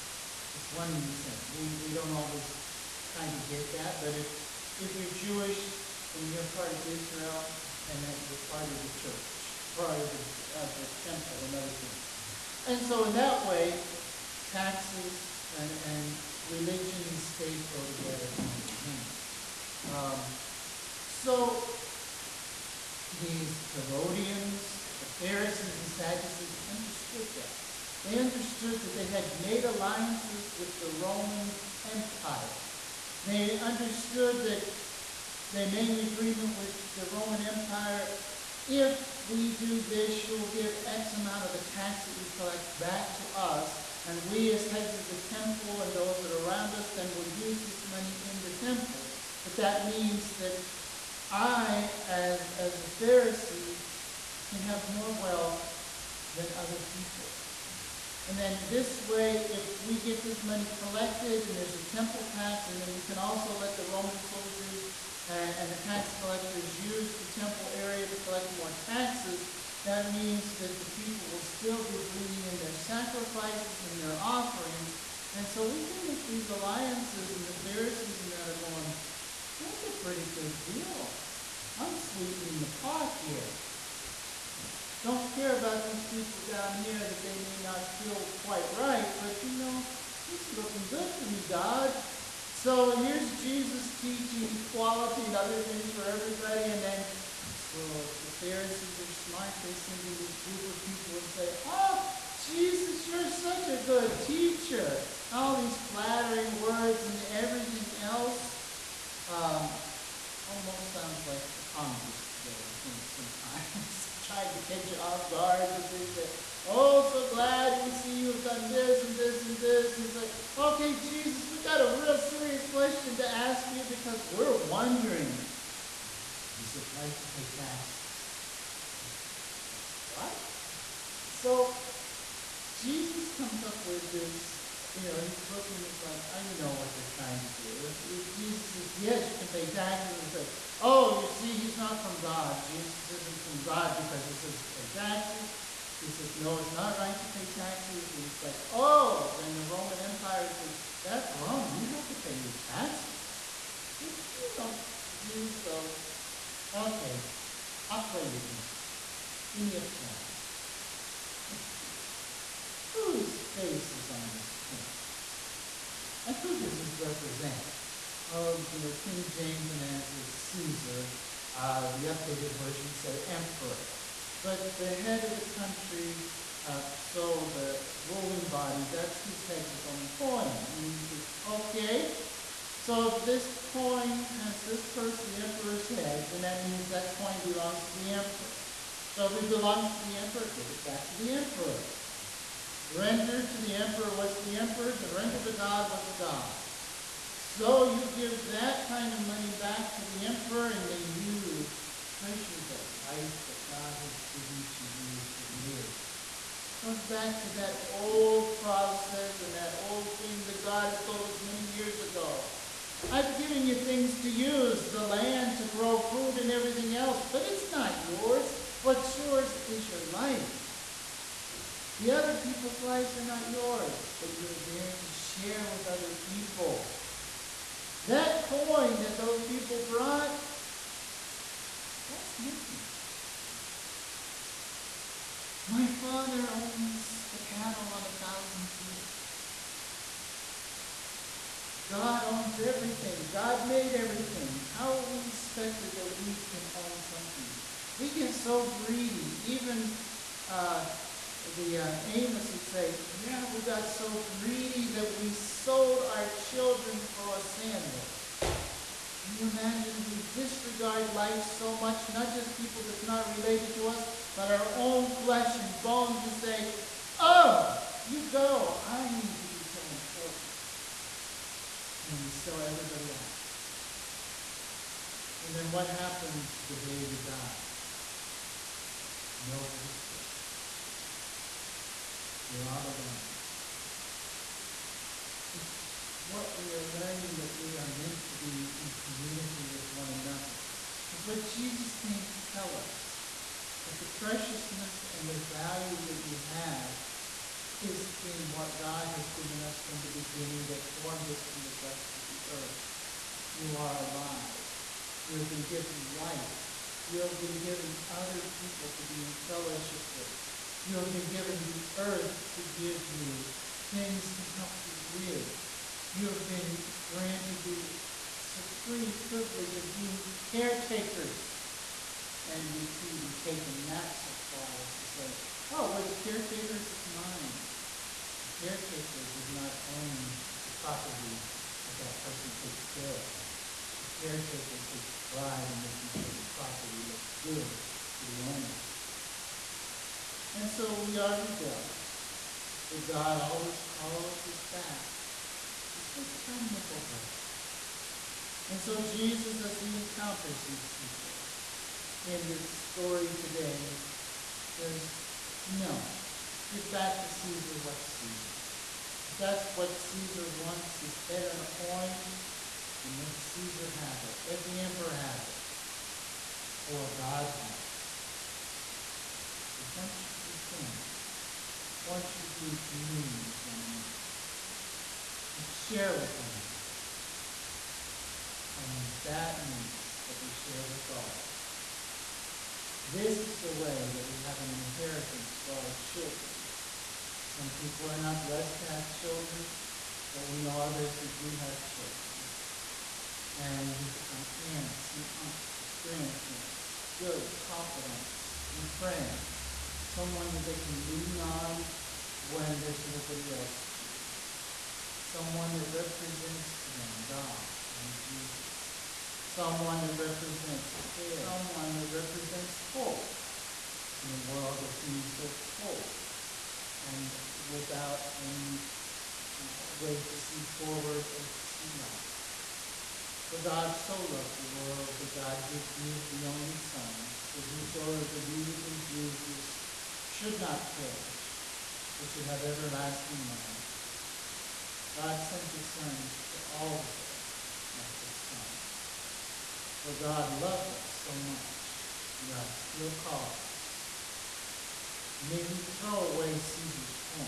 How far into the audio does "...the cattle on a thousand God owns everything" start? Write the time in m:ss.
3:57.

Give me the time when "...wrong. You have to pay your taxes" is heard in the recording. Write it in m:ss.
2:31.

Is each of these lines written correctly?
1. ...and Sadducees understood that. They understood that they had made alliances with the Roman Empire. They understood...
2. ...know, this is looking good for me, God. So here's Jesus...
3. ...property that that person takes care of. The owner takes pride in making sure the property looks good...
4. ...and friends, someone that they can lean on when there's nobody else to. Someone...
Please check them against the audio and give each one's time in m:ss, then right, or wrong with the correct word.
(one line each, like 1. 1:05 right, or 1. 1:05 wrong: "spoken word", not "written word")
1. 0:25 right
2. 1:29 right
3. 5:30 wrong: "caretaker", not "owner"
4. 6:38 right.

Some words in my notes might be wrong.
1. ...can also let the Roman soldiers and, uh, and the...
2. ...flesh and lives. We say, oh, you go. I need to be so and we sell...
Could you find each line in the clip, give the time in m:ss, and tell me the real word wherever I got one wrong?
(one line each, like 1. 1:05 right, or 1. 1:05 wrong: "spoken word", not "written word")
1. 1:03 right
2. 4:25 wrong: "bones", not "lives".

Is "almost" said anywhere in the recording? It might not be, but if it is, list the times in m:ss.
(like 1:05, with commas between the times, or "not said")
1:50.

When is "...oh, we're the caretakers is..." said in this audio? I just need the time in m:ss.
5:25.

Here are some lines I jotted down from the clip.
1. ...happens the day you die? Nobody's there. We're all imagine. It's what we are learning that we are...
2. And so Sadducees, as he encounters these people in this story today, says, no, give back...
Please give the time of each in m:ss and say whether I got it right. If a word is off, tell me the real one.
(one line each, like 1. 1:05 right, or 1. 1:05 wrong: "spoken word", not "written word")
1. 4:35 wrong: "alone", not "imagine"
2. 5:48 wrong: "Jesus", not "Sadducees".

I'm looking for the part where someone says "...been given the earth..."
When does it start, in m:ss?
5:11.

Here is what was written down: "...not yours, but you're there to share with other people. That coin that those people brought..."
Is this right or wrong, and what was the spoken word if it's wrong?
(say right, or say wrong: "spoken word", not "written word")
right.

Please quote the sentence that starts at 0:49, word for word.
But that means that I, as, as a Pharisee, can have more wealth than other people.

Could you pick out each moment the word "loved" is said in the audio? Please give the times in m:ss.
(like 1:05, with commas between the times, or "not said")
7:04, 7:20.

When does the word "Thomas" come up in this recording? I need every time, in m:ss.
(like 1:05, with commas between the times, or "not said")
not said.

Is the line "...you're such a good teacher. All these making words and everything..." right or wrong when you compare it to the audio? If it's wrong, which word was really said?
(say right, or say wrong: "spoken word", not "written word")
wrong: "flattering", not "making".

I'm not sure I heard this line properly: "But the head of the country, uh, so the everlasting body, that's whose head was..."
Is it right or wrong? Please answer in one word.
wrong.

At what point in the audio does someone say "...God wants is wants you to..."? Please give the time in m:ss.
6:07.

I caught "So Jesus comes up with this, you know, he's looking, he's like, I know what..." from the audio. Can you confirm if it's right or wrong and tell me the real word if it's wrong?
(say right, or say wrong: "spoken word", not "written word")
right.